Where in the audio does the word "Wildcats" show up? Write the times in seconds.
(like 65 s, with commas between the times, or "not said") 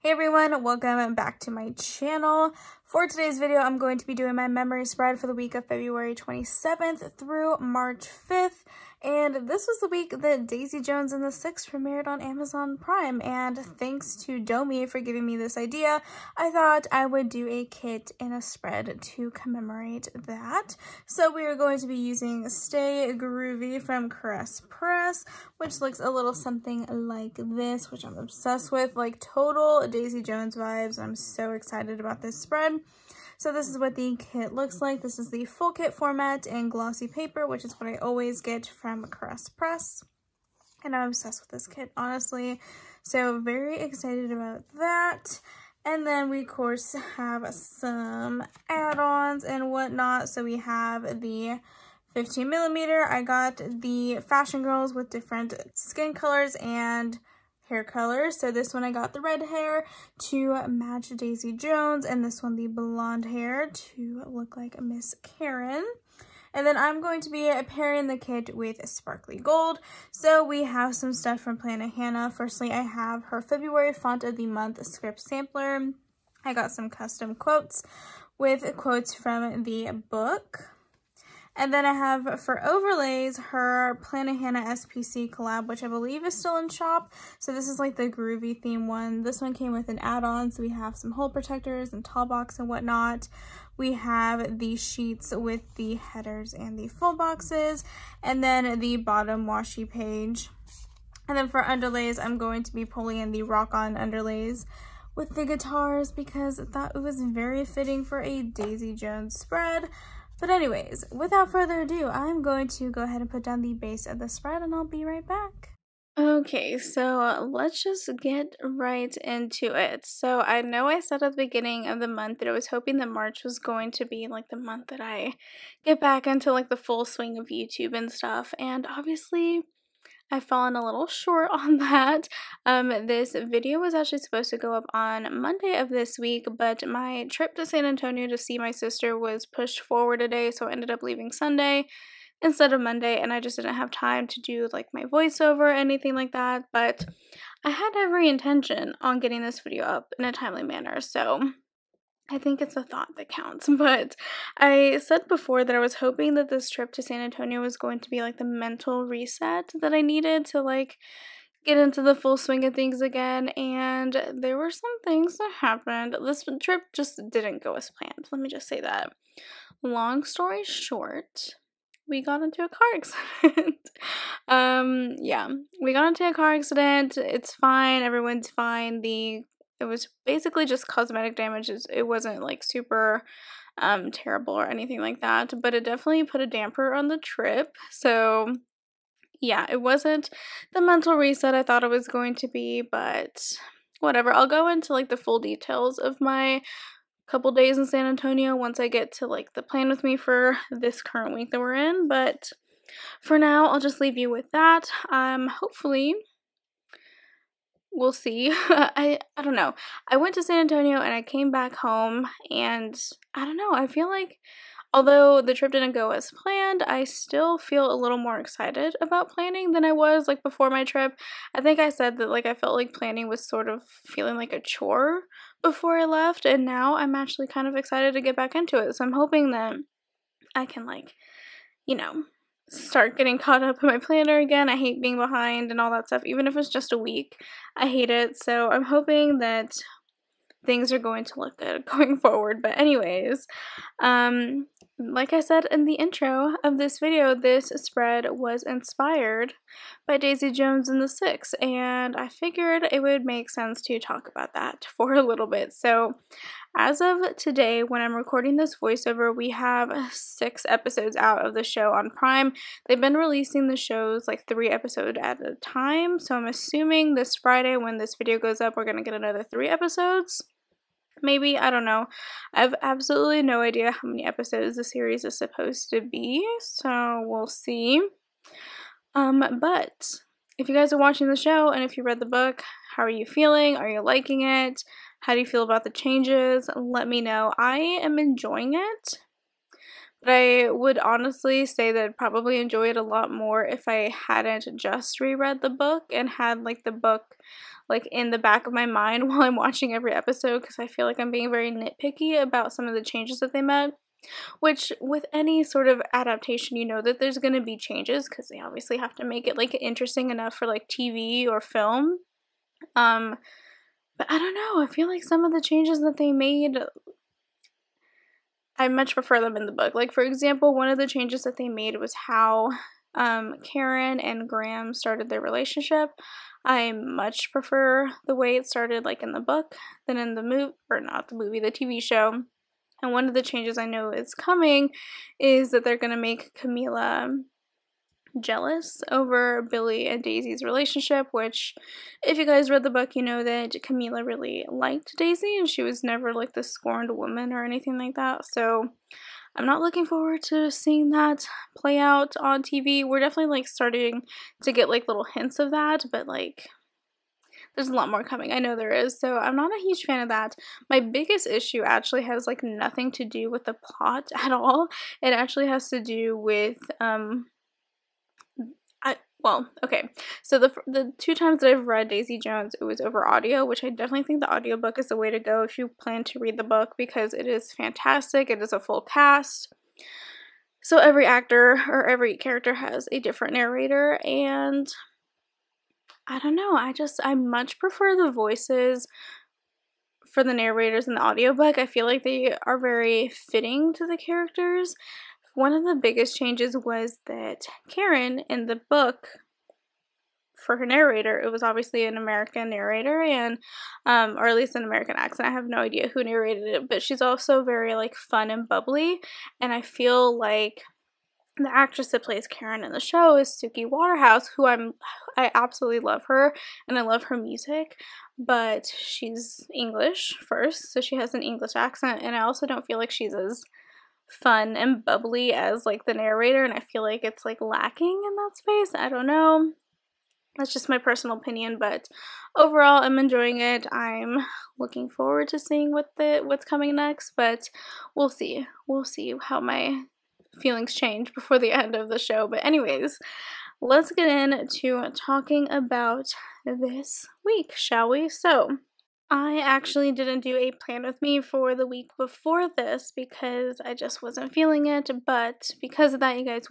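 not said.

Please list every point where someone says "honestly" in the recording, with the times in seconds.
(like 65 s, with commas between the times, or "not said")
41 s, 290 s.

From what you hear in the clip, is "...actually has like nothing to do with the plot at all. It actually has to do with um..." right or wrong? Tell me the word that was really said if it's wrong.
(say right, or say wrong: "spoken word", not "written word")
right.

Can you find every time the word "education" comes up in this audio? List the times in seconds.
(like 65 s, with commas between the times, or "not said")
not said.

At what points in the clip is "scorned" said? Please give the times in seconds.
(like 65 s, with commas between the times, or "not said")
346 s.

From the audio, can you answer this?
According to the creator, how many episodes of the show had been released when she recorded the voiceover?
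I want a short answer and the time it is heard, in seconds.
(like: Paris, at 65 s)
6, at 260 s.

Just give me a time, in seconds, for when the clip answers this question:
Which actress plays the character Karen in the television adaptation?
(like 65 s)
413 s.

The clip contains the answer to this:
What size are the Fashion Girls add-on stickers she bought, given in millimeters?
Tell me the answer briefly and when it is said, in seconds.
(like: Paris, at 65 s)
15 millimeter, at 52 s.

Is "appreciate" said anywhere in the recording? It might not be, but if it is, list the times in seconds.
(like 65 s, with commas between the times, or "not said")
not said.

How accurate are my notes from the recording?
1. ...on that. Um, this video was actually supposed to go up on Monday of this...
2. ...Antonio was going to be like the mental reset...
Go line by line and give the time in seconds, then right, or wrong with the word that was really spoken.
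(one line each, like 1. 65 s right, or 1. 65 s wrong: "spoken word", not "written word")
1. 131 s right
2. 157 s right.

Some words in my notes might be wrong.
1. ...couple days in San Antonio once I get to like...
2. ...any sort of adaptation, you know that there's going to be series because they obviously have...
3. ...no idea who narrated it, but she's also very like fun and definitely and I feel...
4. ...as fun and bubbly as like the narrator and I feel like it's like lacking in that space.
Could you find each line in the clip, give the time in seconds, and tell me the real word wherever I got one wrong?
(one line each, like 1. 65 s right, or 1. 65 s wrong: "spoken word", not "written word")
1. 197 s right
2. 305 s wrong: "changes", not "series"
3. 405 s wrong: "bubbly", not "definitely"
4. 423 s right.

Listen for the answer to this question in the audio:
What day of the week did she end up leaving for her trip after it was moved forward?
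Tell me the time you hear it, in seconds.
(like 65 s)
141 s.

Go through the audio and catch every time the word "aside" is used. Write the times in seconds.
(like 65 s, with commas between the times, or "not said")
not said.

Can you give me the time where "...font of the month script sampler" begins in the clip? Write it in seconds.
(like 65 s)
73 s.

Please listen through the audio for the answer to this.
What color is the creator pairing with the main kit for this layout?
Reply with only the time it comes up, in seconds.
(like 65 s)
68 s.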